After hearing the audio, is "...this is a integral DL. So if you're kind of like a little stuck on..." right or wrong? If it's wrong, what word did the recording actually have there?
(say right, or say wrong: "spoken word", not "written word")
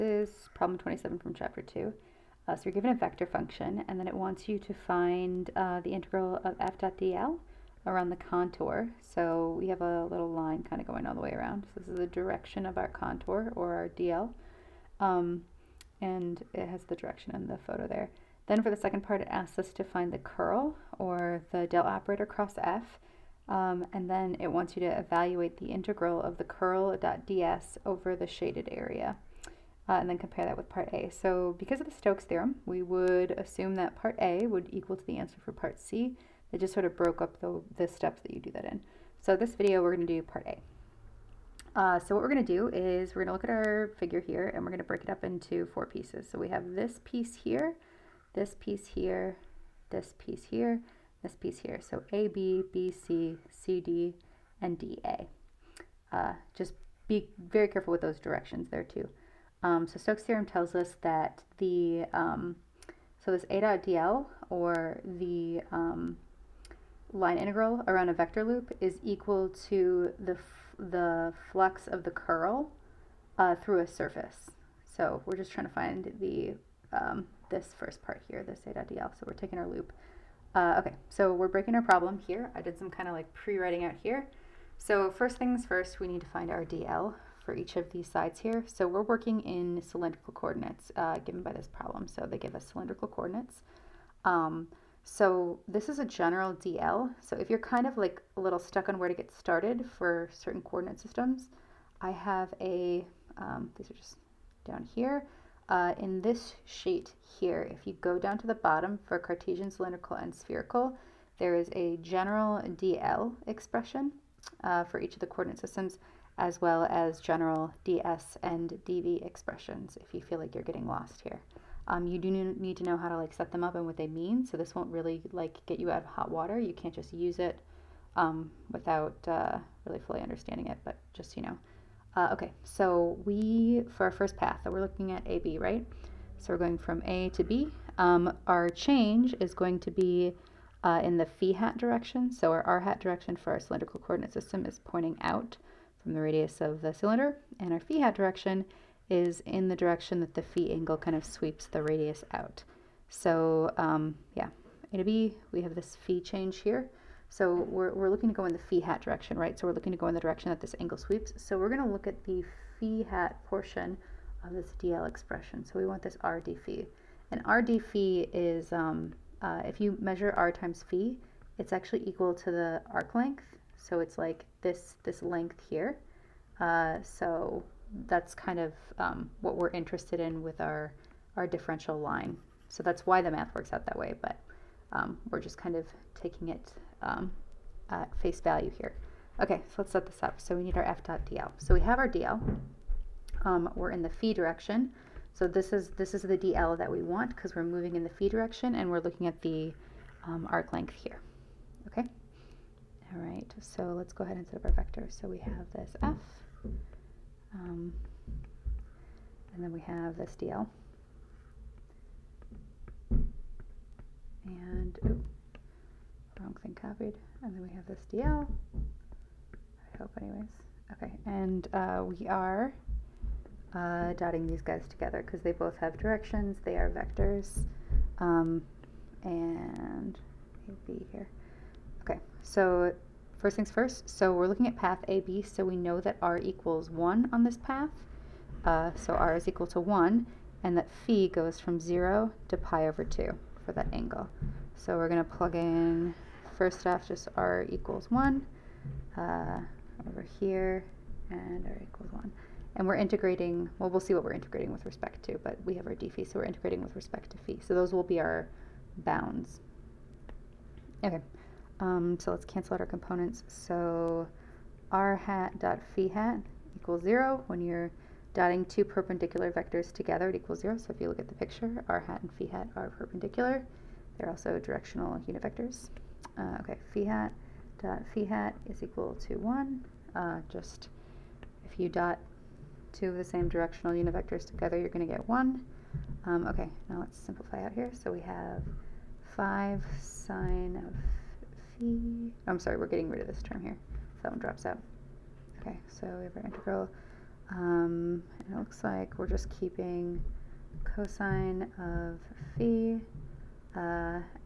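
wrong: "general", not "integral".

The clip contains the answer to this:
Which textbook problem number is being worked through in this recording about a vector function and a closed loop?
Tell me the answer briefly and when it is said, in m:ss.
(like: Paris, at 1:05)
27, at 0:00.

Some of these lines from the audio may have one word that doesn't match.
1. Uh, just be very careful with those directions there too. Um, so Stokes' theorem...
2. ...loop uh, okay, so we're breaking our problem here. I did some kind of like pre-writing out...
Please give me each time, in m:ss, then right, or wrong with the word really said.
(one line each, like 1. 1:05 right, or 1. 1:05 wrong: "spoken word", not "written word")
1. 0:56 right
2. 1:19 right.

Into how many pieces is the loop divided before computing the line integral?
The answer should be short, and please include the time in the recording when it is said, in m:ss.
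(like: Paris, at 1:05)
four, at 0:45.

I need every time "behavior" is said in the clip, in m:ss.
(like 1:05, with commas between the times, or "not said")
not said.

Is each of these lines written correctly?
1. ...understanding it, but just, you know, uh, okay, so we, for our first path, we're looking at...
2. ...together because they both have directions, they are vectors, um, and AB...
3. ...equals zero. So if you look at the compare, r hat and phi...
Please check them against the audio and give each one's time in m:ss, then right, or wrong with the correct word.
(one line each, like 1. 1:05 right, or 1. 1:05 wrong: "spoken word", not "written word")
1. 2:10 right
2. 3:44 right
3. 4:30 wrong: "picture", not "compare".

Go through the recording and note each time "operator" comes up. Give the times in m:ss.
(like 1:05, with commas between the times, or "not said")
0:21.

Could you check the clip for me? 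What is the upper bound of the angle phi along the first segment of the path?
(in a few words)
pi over 2.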